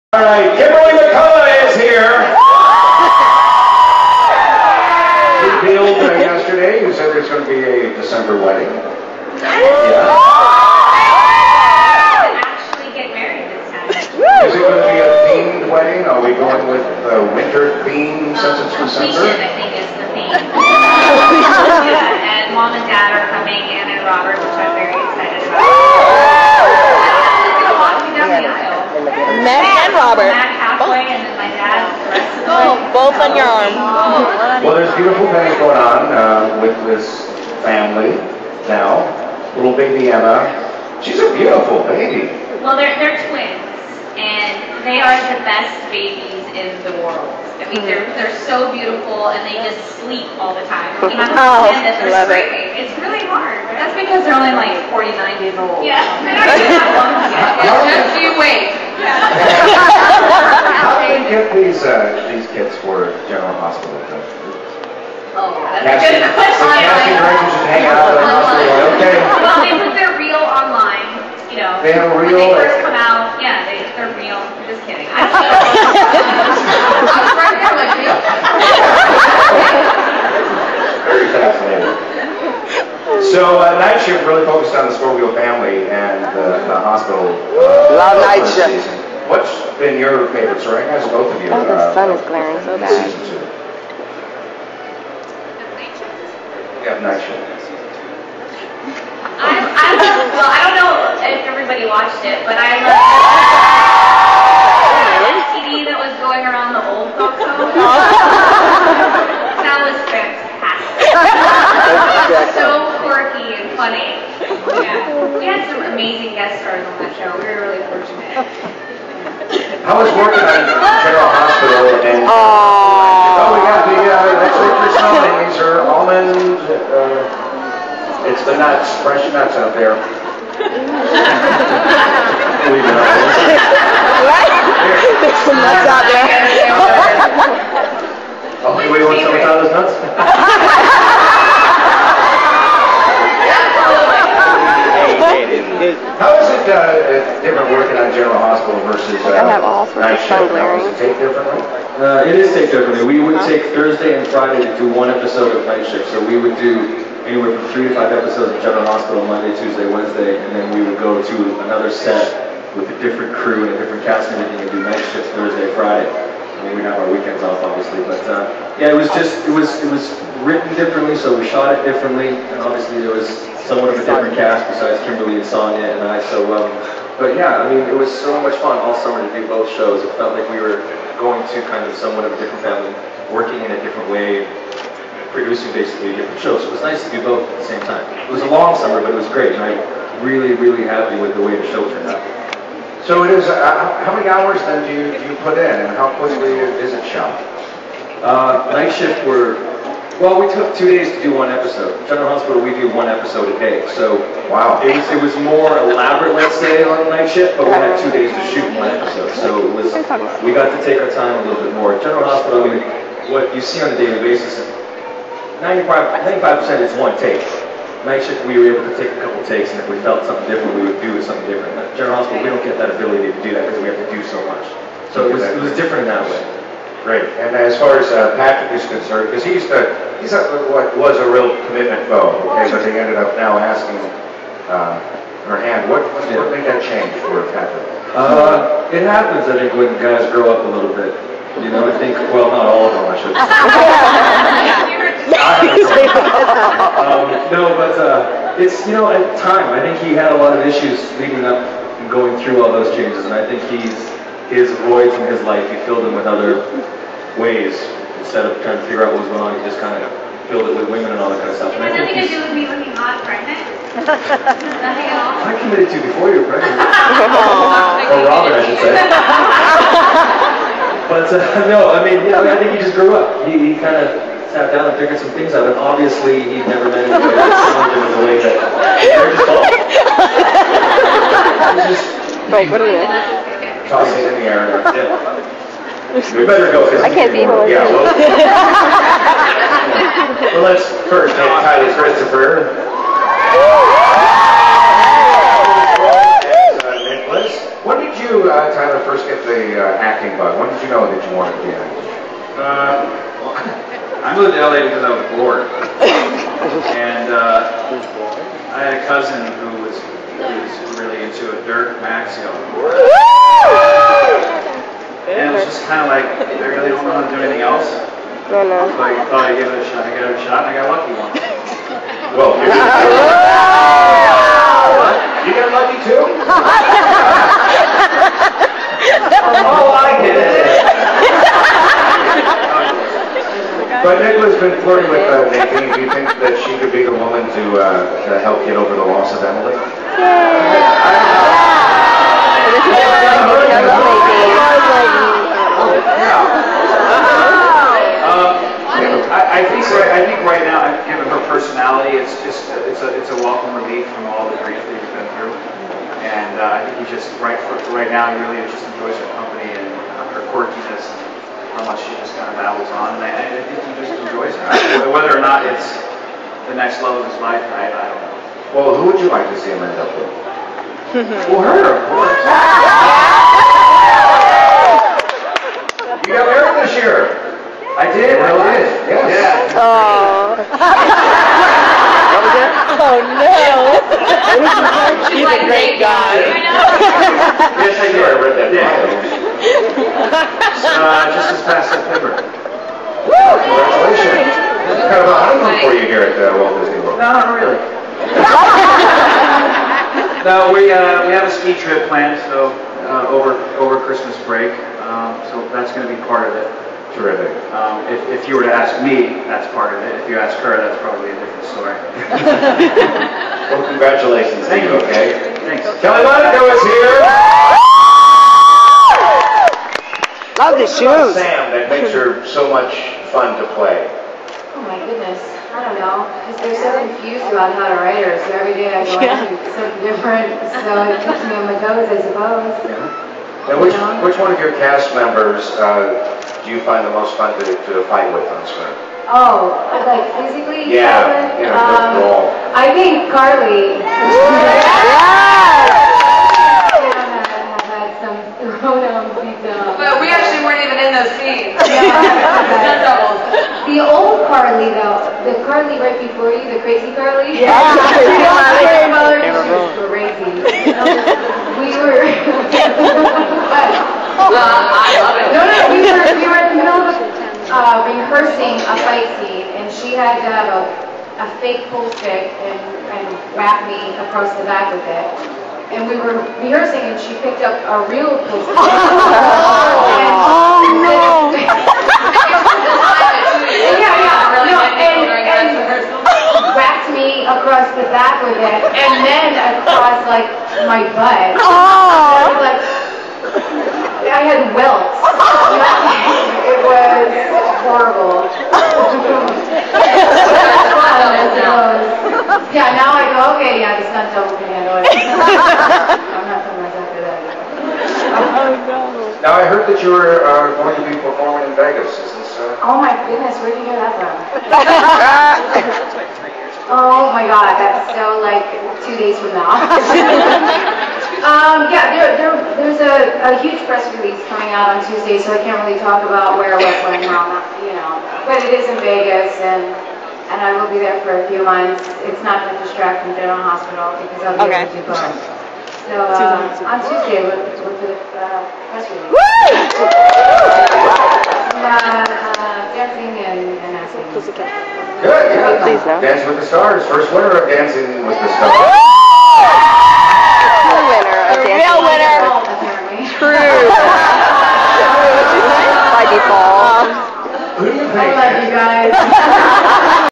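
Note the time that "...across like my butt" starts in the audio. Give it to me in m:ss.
8:09.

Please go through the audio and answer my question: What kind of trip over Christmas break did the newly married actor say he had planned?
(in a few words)
A ski trip.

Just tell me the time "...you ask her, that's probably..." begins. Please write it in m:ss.
6:50.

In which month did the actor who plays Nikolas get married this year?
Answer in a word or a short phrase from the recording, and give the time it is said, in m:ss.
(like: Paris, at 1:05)
September, at 6:31.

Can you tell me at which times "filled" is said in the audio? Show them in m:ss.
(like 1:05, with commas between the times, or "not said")
4:15, 4:20.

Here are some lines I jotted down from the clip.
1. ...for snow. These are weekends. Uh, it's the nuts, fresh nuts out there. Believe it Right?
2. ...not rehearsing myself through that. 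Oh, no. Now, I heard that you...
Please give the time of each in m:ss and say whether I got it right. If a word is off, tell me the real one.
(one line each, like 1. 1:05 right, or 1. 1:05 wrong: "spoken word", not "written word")
1. 2:04 wrong: "almonds", not "weekends"
2. 8:26 wrong: "putting", not "rehearsing".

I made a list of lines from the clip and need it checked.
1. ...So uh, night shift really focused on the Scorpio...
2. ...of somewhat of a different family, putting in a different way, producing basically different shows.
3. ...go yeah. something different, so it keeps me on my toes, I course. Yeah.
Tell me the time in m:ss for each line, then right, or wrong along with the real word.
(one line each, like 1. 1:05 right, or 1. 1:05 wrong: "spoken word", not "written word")
1. 1:23 right
2. 3:01 wrong: "working", not "putting"
3. 7:09 wrong: "suppose", not "course".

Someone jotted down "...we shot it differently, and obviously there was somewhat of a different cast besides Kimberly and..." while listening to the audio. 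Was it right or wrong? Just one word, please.
right.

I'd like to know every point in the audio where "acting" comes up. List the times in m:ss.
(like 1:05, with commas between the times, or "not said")
4:59, 9:03.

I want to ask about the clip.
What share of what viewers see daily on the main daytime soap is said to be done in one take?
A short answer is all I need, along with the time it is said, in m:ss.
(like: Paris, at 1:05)
95 percent, at 3:35.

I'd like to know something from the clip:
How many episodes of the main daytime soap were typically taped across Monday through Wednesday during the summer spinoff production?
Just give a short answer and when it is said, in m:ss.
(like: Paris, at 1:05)
3 to 5, at 2:37.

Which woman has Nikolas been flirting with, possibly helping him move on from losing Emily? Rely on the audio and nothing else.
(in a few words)
Nadine.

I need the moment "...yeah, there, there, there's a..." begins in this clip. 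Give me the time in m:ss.
8:41.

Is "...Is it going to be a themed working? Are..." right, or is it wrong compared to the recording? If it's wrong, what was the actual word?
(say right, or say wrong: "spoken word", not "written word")
wrong: "wedding", not "working".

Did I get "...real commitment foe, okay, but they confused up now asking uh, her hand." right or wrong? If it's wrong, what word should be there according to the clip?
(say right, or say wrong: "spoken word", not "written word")
wrong: "ended", not "confused".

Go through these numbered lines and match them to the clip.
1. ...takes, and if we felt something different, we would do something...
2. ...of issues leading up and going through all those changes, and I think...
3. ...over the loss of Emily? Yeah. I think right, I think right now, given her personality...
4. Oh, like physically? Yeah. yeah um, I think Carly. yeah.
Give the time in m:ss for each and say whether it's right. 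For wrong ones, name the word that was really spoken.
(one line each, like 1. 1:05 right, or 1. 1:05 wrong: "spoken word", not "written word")
1. 3:39 right
2. 4:10 right
3. 5:38 right
4. 7:19 right.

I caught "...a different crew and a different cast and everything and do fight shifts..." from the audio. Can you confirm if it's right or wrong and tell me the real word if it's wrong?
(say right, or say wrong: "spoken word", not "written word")
wrong: "night", not "fight".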